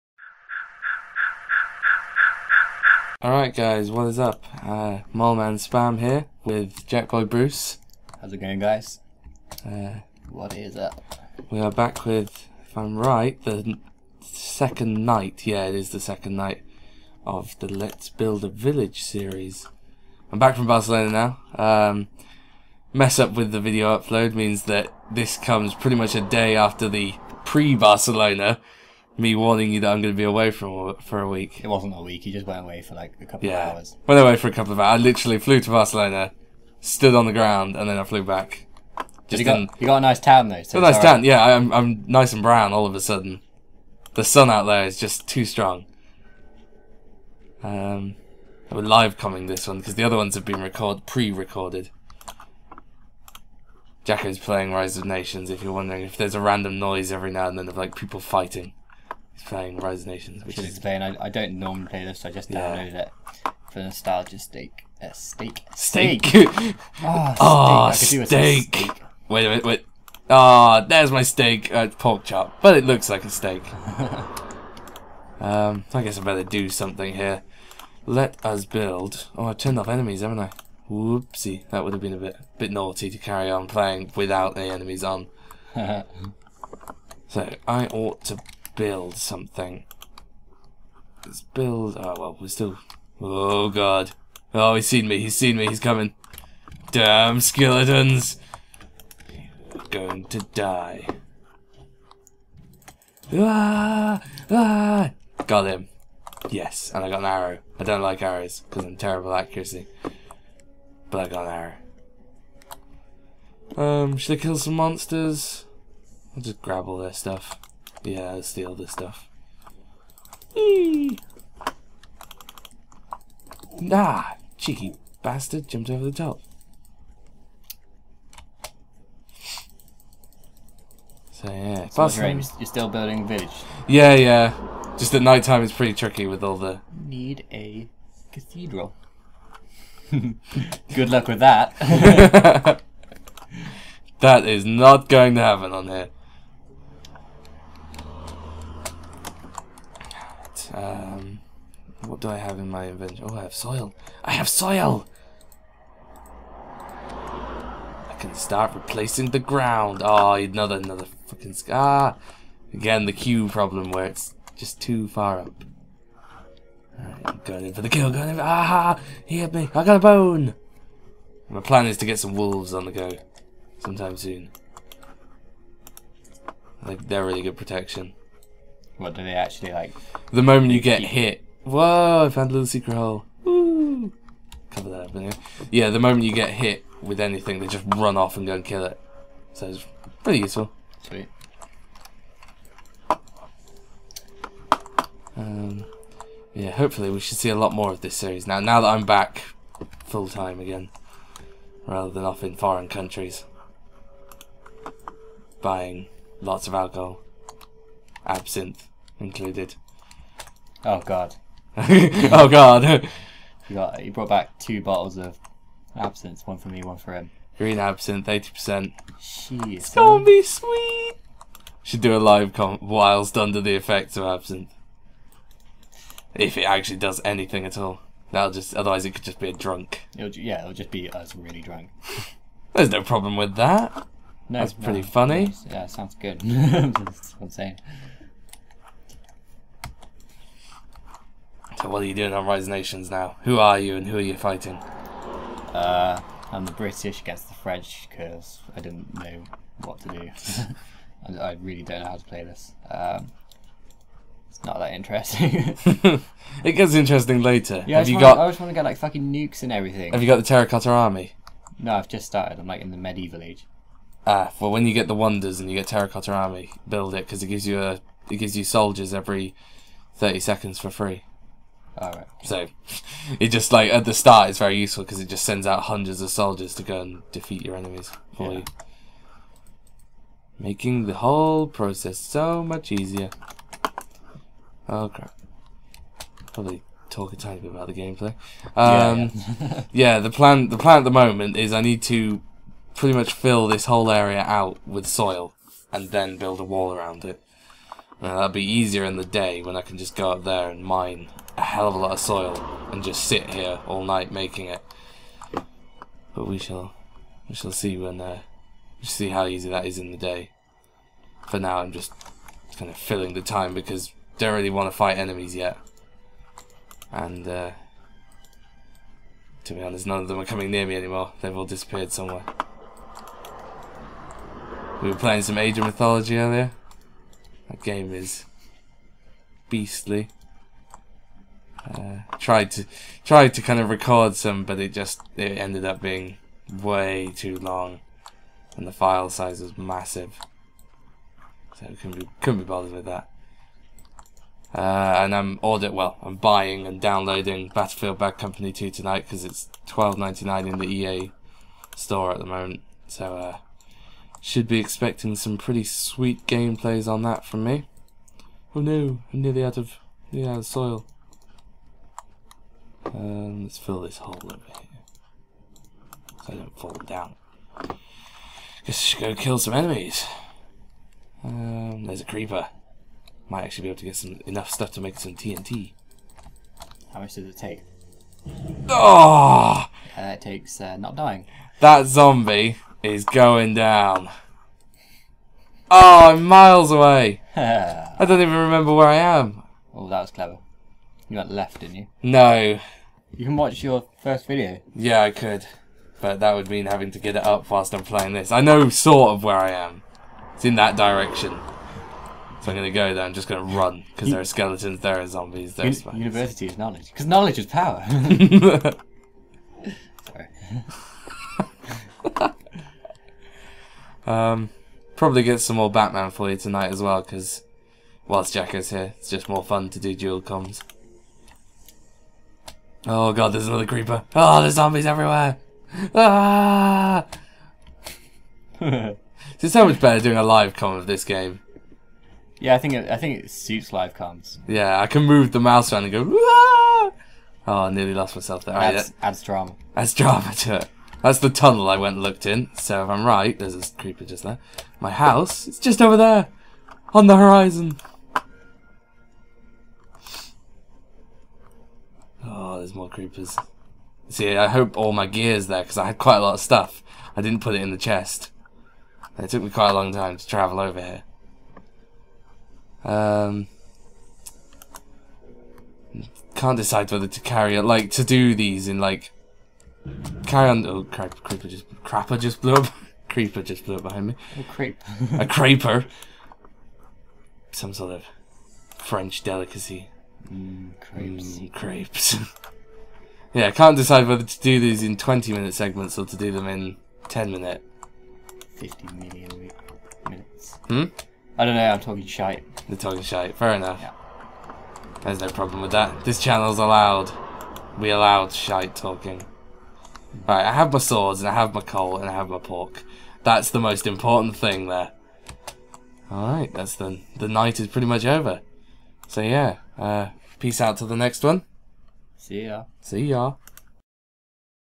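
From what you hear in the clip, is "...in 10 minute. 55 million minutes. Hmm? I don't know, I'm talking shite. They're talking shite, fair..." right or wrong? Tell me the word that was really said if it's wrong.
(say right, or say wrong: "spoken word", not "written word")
wrong: "50", not "55".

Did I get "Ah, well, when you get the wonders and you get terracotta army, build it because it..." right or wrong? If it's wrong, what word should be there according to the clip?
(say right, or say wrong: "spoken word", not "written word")
right.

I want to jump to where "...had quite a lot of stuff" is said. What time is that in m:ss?
7:36.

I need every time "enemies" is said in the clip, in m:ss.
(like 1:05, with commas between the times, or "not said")
1:19, 1:24, 4:37, 5:15, 6:09.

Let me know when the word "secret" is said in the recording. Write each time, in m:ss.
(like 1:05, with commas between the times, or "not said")
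3:02.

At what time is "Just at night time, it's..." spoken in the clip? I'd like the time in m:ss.
2:14.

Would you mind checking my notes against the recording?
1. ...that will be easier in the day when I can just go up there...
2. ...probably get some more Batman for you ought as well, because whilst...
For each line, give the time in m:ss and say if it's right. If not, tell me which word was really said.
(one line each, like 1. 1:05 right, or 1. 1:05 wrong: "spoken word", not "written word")
1. 4:58 right
2. 6:55 wrong: "tonight", not "ought".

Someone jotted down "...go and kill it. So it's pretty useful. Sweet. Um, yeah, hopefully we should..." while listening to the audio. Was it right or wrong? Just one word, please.
right.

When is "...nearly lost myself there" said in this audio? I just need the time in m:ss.
7:17.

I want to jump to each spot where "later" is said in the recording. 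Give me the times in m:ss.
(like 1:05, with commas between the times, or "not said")
4:17.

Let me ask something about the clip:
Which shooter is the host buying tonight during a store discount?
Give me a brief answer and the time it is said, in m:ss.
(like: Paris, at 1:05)
Battlefield Bad Company 2, at 5:47.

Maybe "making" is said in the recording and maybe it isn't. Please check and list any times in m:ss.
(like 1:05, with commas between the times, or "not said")
4:40, 5:04.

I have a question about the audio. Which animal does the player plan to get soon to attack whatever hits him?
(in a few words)
wolves.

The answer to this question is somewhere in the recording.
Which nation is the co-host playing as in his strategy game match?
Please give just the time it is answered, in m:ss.
4:06.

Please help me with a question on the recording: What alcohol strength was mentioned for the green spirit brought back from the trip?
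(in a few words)
80 percent.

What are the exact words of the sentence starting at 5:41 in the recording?
So couldn't be couldn't be bothered with that.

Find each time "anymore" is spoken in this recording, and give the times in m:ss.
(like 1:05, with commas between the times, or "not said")
5:20.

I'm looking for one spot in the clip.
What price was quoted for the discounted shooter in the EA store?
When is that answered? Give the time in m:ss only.
5:49.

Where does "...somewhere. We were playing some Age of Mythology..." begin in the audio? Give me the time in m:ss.
5:22.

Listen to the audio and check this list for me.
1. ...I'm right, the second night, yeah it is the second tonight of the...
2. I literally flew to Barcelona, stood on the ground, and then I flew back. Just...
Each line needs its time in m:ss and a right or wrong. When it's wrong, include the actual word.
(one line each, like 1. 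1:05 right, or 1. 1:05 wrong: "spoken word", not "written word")
1. 0:12 wrong: "night", not "tonight"
2. 0:34 right.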